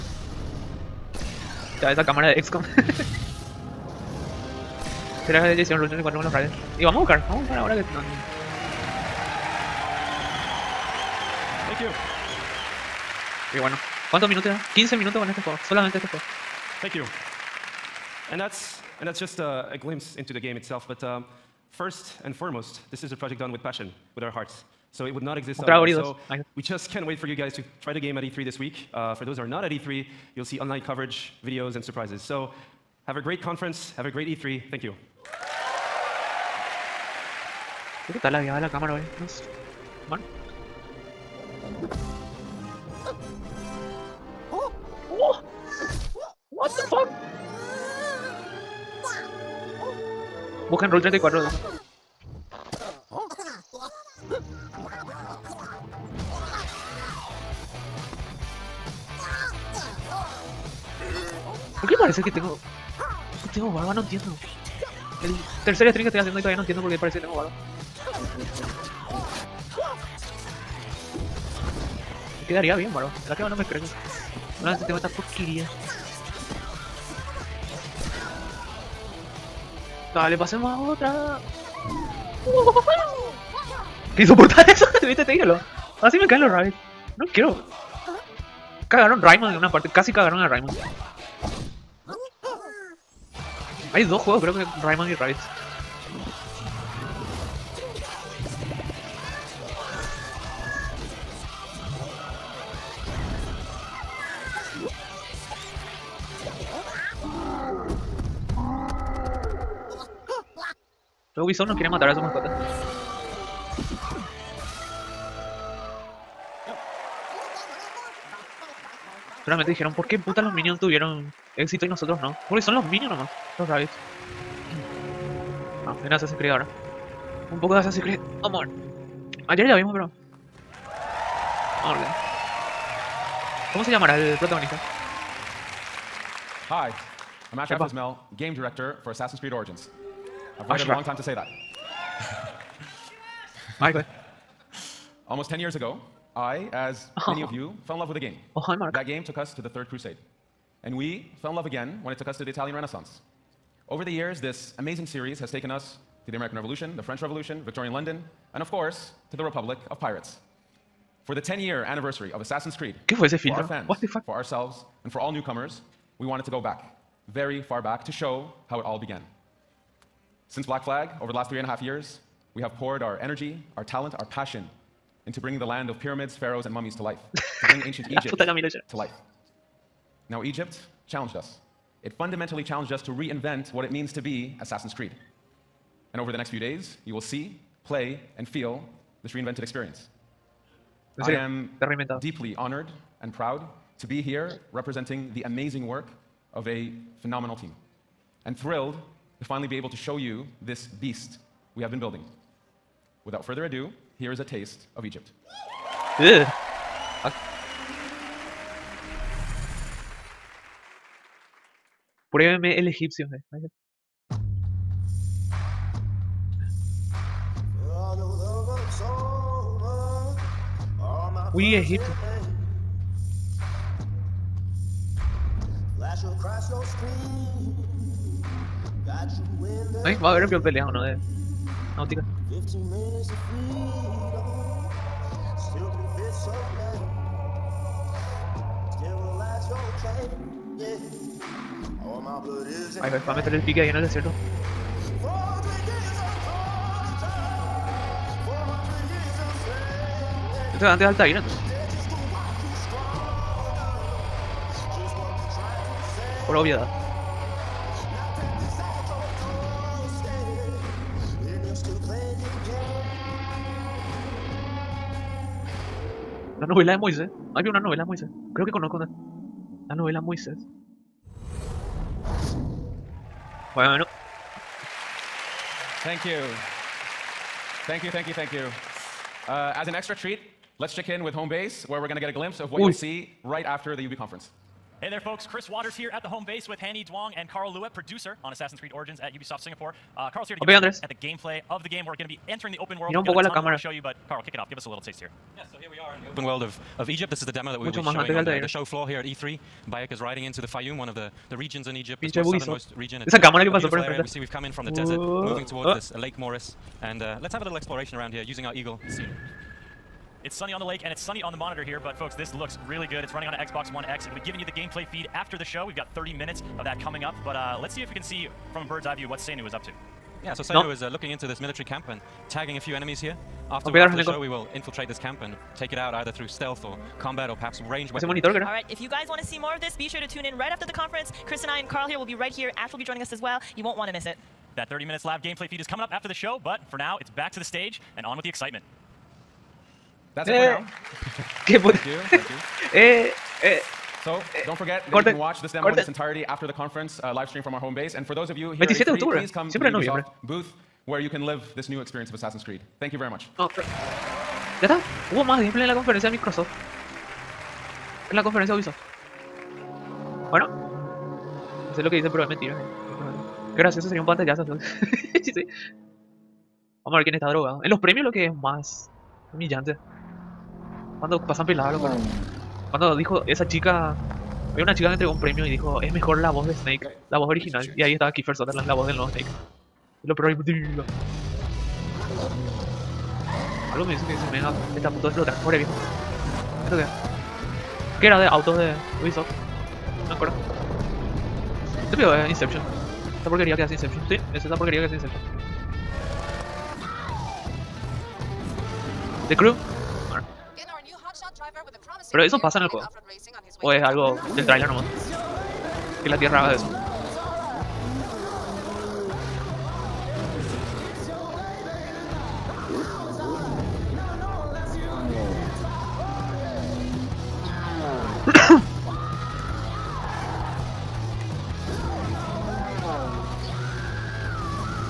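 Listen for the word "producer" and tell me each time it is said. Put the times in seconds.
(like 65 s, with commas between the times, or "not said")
287 s.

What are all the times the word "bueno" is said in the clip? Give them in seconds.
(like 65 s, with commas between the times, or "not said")
13 s, 273 s, 360 s.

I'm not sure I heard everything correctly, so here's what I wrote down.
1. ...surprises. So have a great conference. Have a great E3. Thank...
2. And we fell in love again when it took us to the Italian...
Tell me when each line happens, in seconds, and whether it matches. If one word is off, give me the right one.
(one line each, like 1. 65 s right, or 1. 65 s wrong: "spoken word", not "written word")
1. 31 s right
2. 150 s right.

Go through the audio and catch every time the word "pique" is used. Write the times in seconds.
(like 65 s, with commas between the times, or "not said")
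243 s.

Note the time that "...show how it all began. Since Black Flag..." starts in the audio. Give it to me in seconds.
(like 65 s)
168 s.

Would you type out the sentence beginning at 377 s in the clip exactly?
Y ahí estaba Kiefer Sutherland, la voz del nuevo Snake.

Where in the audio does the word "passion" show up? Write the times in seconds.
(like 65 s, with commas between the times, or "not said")
23 s, 174 s.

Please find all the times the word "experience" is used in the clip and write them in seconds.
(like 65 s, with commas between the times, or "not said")
189 s, 352 s.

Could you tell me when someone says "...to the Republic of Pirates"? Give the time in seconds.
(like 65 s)
159 s.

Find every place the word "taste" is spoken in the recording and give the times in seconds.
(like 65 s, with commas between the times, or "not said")
204 s, 295 s.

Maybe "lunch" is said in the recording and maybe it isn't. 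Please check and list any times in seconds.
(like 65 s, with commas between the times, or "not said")
not said.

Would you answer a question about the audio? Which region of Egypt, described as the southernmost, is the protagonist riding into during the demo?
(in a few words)
the Fayum.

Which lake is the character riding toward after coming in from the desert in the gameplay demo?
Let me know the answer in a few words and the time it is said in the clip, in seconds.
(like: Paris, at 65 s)
Lake Moeris, at 306 s.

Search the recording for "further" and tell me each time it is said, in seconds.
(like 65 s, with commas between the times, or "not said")
203 s.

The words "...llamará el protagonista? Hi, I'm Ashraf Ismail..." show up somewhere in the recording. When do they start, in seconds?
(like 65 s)
133 s.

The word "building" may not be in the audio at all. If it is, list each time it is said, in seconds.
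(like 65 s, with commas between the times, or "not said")
201 s.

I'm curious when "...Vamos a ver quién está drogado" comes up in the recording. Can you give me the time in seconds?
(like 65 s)
364 s.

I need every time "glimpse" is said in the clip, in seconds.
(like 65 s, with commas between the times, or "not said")
19 s, 282 s.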